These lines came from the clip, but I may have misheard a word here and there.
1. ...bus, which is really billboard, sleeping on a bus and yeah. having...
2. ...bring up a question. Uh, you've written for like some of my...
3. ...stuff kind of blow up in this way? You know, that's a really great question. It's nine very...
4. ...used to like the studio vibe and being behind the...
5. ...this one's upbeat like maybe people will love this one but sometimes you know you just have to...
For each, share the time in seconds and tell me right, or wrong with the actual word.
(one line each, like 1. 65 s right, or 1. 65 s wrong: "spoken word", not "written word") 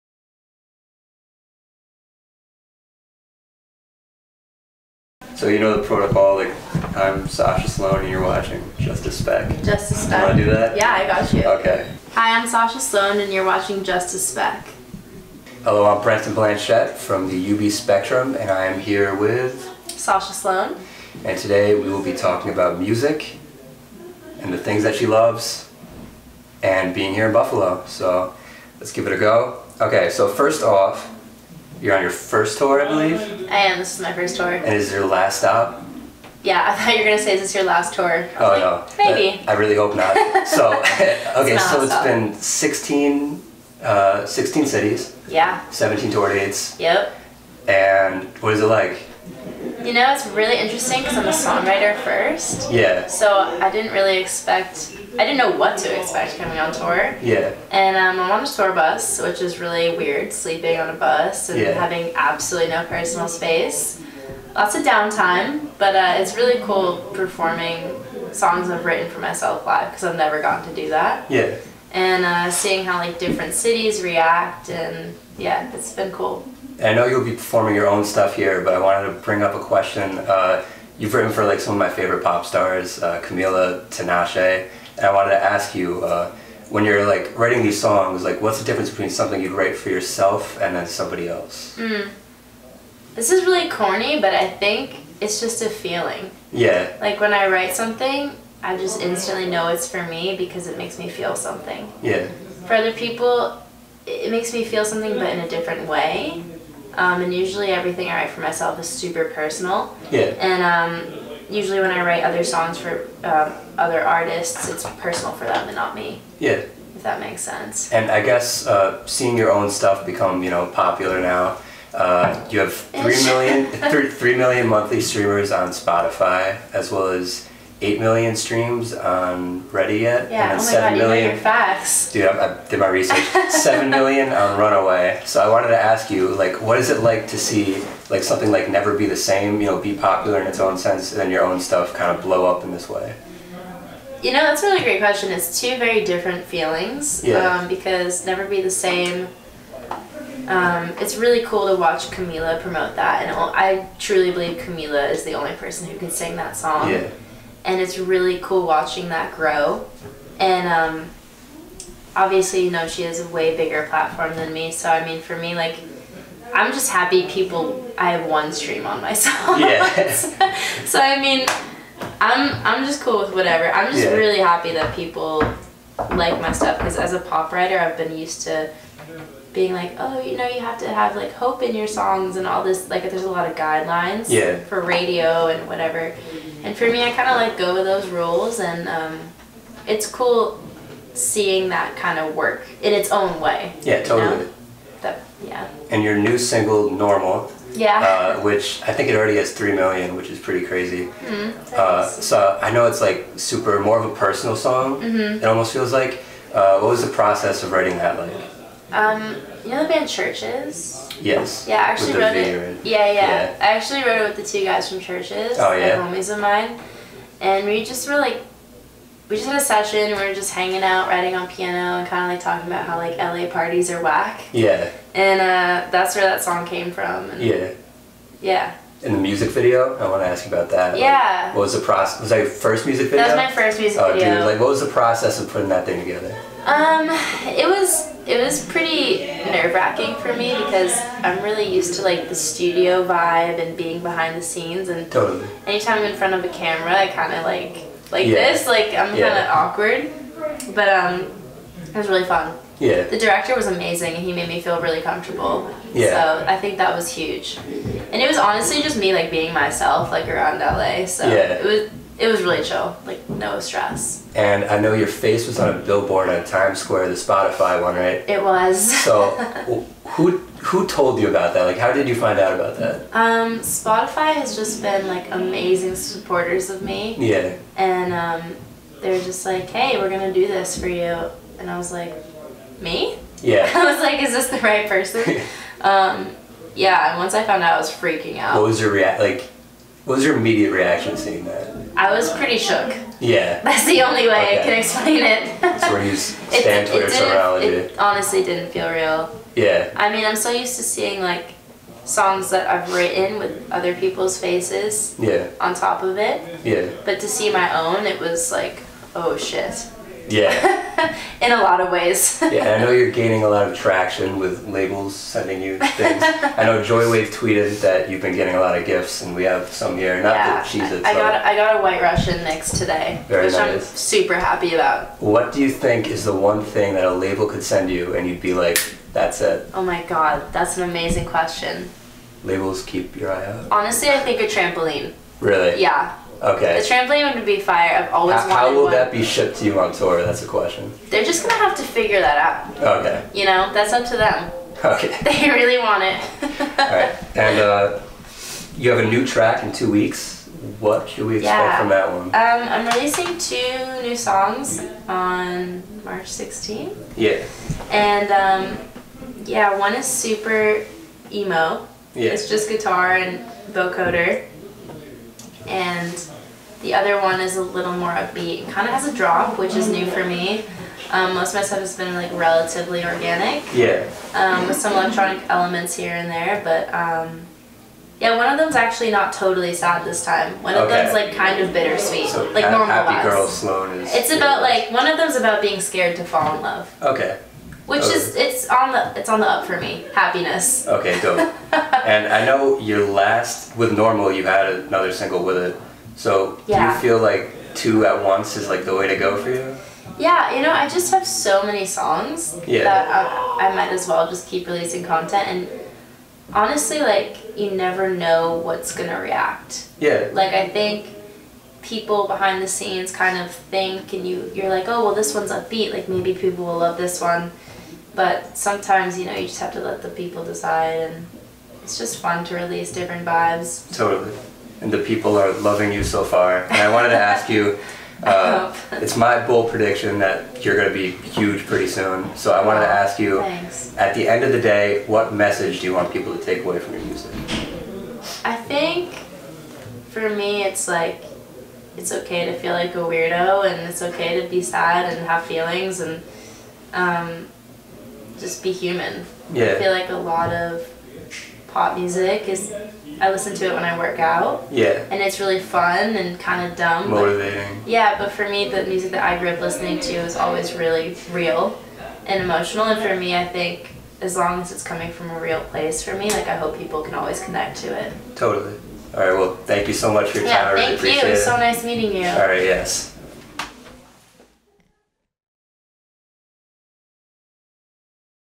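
1. 58 s wrong: "weird", not "billboard"
2. 79 s right
3. 141 s wrong: "two", not "nine"
4. 241 s right
5. 415 s right.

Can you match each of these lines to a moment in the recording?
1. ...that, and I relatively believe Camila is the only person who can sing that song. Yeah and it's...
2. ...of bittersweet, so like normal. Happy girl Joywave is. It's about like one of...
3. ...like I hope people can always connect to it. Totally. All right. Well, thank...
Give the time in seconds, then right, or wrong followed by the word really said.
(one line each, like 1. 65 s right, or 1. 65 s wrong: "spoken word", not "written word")
1. 152 s wrong: "truly", not "relatively"
2. 381 s wrong: "Sloan", not "Joywave"
3. 466 s right.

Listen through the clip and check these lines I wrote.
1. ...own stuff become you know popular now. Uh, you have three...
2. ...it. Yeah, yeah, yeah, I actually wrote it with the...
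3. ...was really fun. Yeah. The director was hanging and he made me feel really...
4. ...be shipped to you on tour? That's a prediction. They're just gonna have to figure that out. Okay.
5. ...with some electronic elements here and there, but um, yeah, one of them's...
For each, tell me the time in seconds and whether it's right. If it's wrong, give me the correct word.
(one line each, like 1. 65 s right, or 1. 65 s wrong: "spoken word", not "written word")
1. 119 s right
2. 212 s right
3. 251 s wrong: "amazing", not "hanging"
4. 339 s wrong: "question", not "prediction"
5. 374 s right.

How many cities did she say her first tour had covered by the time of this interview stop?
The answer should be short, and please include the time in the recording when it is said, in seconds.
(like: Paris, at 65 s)
16, at 44 s.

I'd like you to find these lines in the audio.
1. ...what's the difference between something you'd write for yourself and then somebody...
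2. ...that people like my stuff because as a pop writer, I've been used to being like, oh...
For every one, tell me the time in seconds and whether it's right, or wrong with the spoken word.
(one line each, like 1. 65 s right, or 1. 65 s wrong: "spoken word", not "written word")
1. 88 s right
2. 174 s right.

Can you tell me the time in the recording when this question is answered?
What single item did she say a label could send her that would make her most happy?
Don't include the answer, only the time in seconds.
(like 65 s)
334 s.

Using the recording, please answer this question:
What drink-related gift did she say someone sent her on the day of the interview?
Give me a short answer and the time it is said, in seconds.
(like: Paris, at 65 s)
White Russian mix, at 321 s.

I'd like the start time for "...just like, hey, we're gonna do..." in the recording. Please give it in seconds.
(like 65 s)
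279 s.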